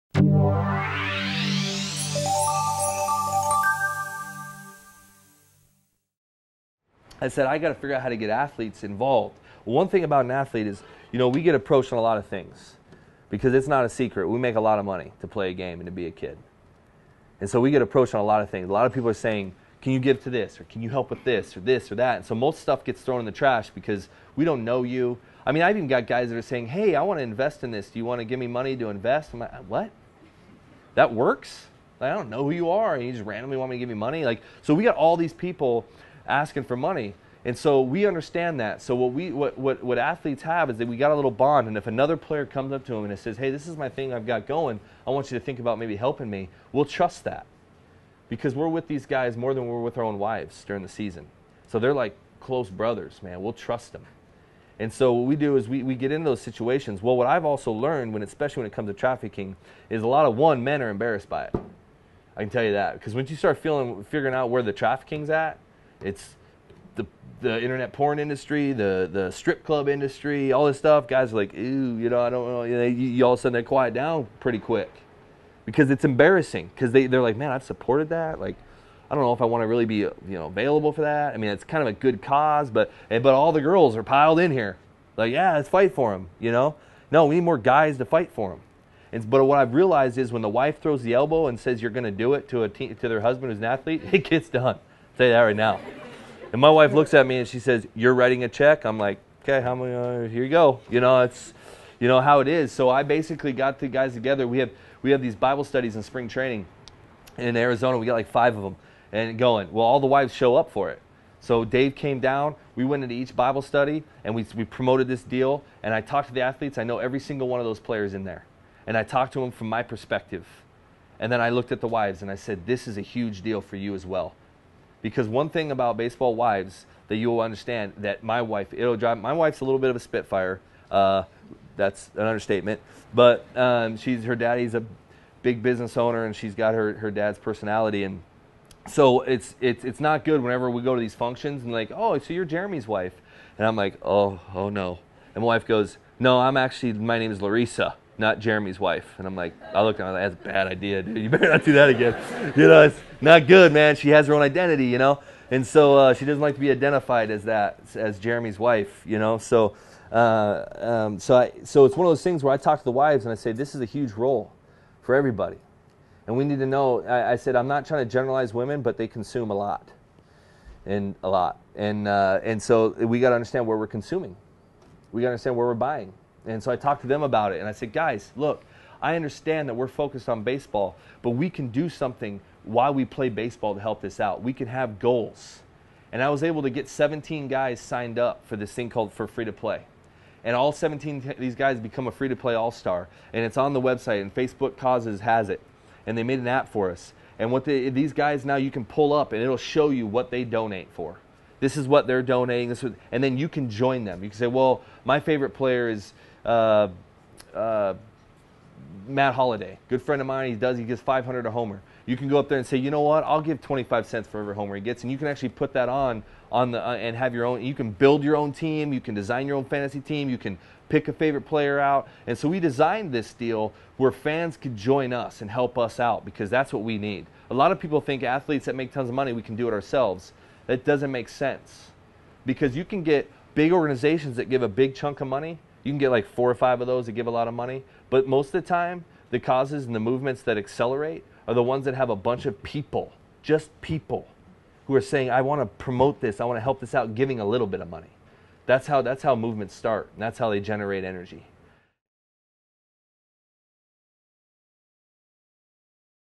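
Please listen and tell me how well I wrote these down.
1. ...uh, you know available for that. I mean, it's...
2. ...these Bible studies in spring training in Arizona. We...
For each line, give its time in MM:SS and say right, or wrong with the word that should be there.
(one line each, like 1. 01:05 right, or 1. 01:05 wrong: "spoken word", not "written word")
1. 01:20 right
2. 01:45 right.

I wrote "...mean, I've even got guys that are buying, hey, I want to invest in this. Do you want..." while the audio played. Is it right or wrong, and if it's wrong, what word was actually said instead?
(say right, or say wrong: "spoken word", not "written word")
wrong: "saying", not "buying".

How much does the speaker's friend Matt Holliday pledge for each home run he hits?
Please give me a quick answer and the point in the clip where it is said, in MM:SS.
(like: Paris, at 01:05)
500, at 03:31.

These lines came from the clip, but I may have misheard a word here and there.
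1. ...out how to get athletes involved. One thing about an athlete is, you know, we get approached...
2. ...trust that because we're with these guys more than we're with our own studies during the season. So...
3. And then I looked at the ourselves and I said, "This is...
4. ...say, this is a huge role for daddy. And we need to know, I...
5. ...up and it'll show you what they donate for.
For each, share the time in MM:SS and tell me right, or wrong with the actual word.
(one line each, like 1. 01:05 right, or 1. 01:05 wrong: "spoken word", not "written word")
1. 00:07 right
2. 00:46 wrong: "wives", not "studies"
3. 02:01 wrong: "wives", not "ourselves"
4. 02:43 wrong: "everybody", not "daddy"
5. 03:19 right.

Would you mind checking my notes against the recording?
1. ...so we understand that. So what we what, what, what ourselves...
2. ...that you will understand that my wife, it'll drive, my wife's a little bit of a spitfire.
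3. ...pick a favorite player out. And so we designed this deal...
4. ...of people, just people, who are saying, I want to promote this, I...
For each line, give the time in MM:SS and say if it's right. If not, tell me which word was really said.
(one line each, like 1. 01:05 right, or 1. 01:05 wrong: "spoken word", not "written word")
1. 00:37 wrong: "athletes", not "ourselves"
2. 02:07 right
3. 03:40 right
4. 04:02 right.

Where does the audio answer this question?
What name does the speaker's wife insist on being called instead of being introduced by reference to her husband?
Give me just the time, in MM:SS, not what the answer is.
02:27.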